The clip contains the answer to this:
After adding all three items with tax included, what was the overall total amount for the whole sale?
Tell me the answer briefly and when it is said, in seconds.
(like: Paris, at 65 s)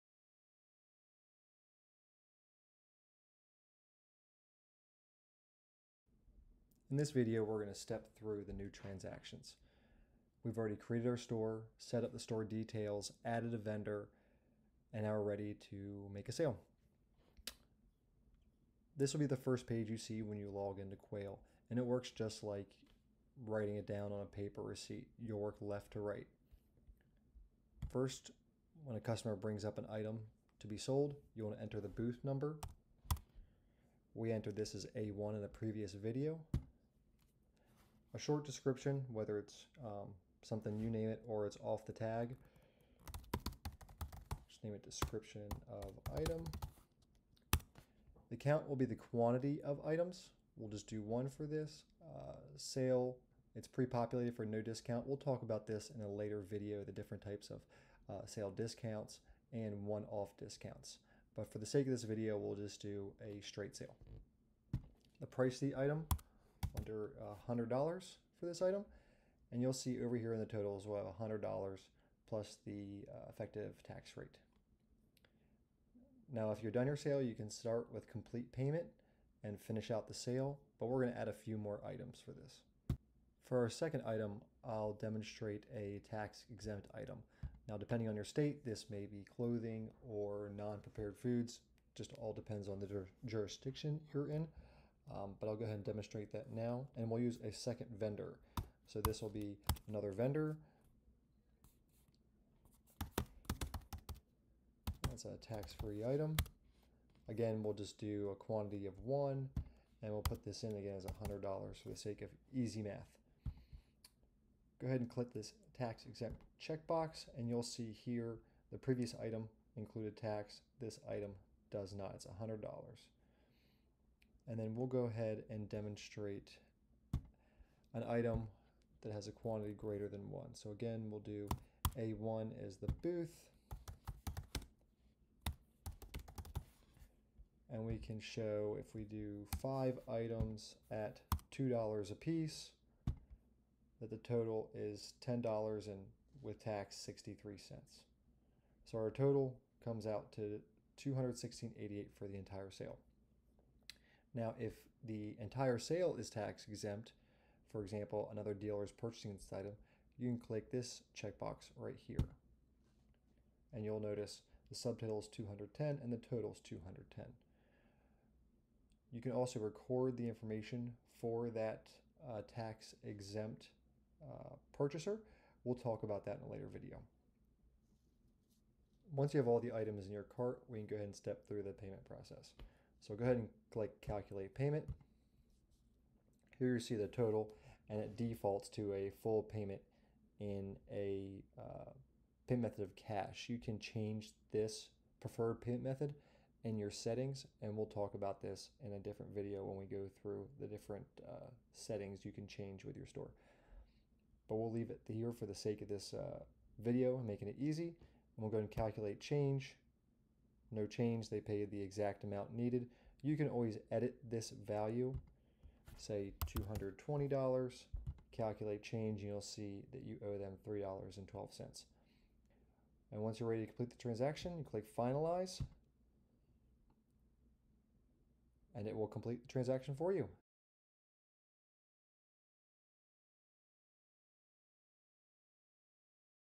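$216.88, at 151 s.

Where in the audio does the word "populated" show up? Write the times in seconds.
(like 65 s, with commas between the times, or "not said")
53 s.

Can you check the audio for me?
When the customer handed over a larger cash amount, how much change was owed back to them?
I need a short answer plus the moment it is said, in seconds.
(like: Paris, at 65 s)
$3.12, at 220 s.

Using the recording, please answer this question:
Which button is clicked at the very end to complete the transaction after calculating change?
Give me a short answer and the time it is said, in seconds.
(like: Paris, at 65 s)
Finalize, at 224 s.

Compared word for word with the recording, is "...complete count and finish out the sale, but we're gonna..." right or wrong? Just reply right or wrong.
wrong.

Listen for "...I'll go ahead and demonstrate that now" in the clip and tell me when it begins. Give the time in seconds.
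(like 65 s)
95 s.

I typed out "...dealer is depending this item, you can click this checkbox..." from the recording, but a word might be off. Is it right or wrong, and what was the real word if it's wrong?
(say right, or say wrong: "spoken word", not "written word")
wrong: "purchasing", not "depending".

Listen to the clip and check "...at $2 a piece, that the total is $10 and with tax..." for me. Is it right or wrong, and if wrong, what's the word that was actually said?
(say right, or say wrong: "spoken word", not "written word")
right.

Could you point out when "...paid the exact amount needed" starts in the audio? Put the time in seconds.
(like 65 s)
211 s.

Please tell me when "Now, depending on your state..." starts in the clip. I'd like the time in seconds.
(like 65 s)
87 s.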